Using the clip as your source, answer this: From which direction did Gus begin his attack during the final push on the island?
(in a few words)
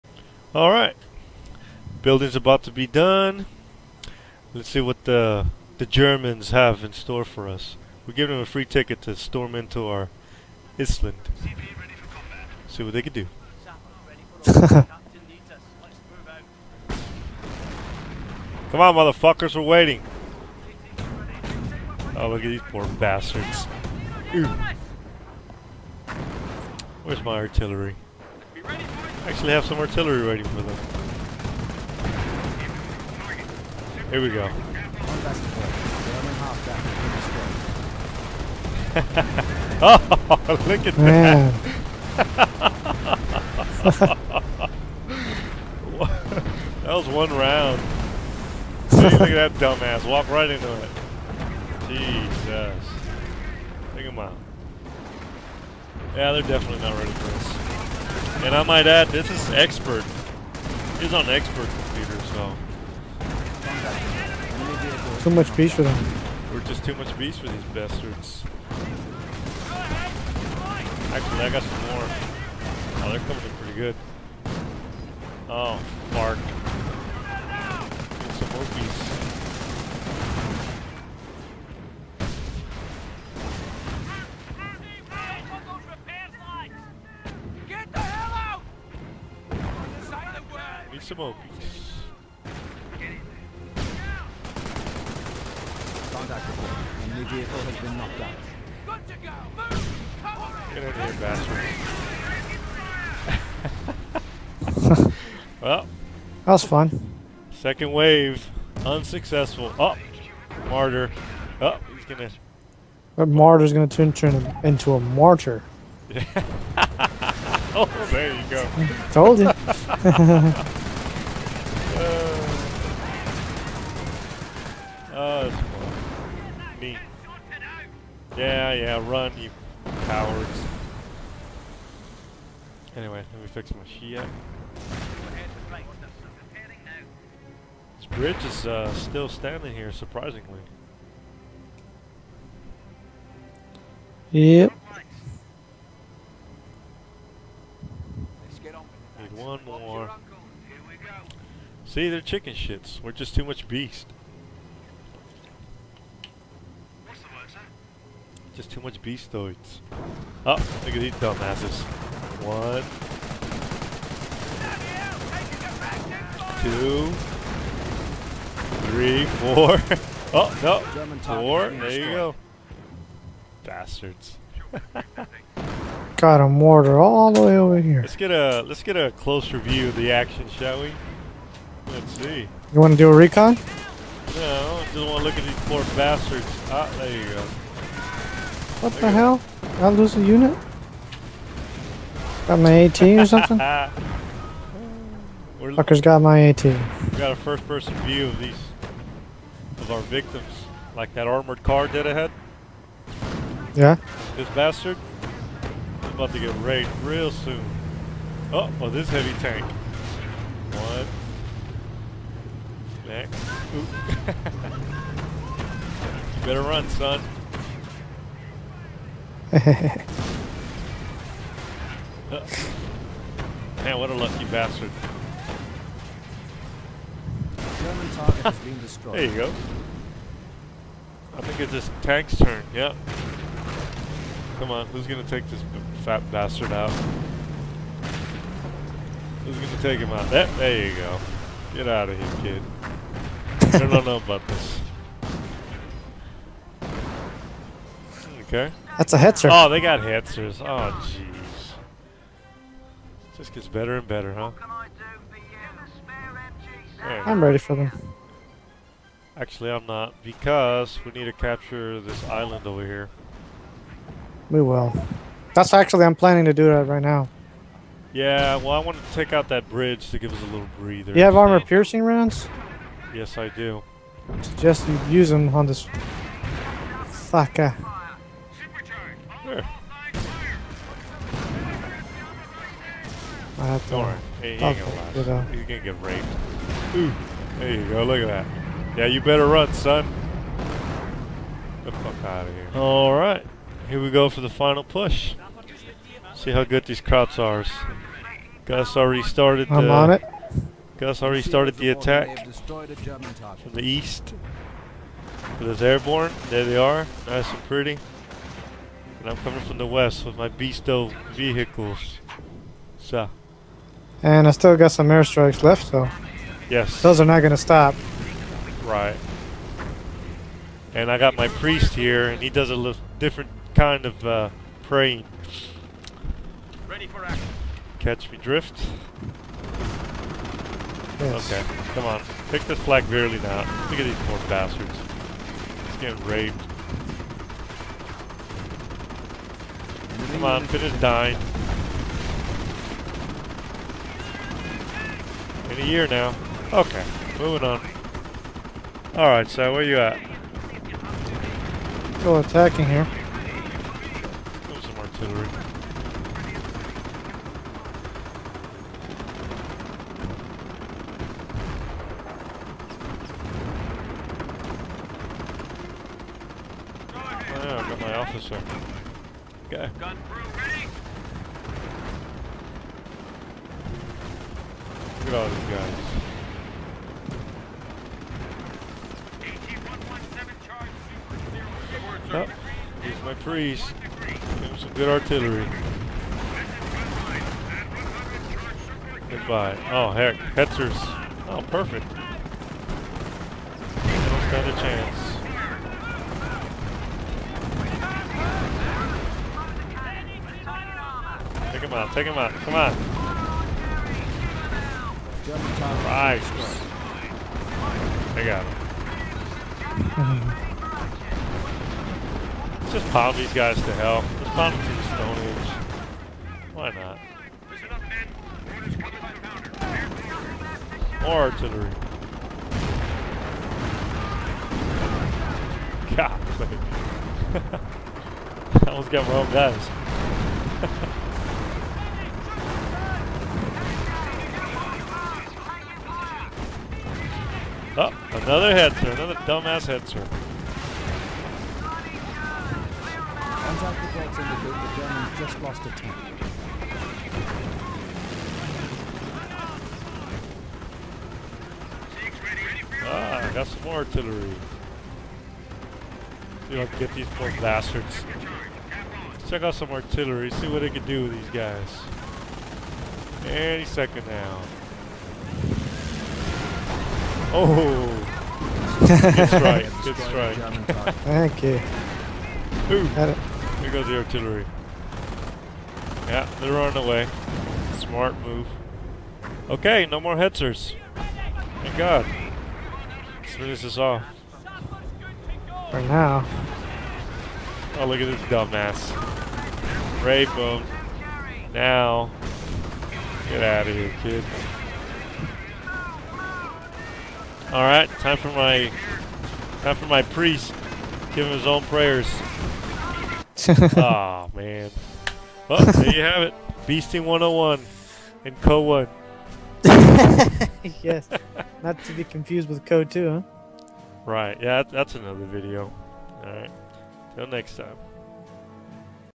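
East.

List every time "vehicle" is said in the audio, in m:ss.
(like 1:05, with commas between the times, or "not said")
1:37, 5:11.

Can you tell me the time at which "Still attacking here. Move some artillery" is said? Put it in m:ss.
5:52.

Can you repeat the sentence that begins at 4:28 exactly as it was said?
Yeah, well, I want to take out that bridge to give us a little breather.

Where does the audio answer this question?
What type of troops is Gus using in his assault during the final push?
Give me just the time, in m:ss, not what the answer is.
5:05.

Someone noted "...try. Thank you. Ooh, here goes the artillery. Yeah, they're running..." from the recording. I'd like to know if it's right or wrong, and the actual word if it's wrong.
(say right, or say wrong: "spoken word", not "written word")
right.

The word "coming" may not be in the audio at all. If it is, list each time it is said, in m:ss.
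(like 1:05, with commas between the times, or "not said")
1:13, 5:09.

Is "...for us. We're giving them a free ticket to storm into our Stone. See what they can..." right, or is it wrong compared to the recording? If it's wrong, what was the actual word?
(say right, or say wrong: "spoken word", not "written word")
wrong: "Island", not "Stone".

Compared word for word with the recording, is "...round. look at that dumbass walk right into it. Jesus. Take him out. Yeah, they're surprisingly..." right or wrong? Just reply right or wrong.
wrong.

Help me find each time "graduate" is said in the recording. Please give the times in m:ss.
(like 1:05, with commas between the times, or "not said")
not said.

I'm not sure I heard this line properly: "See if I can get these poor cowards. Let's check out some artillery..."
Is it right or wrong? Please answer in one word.
wrong.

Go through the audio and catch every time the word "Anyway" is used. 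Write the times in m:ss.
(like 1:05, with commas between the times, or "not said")
2:12.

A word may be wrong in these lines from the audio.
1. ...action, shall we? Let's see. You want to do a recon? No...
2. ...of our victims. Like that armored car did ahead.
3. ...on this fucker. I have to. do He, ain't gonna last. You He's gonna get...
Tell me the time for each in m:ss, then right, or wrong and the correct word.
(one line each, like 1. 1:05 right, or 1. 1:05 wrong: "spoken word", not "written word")
1. 3:00 right
2. 3:19 right
3. 4:35 right.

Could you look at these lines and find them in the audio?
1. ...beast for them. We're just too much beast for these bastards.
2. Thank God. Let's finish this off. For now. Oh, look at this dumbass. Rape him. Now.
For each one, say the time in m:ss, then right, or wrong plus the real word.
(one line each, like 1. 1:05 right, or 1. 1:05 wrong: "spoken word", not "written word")
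1. 1:05 right
2. 8:01 right.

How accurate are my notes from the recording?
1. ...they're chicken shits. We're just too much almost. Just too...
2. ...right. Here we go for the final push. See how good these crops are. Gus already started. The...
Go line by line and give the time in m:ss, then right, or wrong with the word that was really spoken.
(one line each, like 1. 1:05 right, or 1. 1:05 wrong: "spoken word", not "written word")
1. 2:32 wrong: "beast", not "almost"
2. 4:53 right.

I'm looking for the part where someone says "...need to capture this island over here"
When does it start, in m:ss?
4:21.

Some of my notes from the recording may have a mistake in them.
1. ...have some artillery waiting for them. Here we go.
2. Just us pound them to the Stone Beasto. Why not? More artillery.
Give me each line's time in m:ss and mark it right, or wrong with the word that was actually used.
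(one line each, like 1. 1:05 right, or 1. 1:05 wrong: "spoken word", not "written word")
1. 0:29 right
2. 6:54 wrong: "Age", not "Beasto".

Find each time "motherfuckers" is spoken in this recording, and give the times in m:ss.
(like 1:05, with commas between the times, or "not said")
0:18.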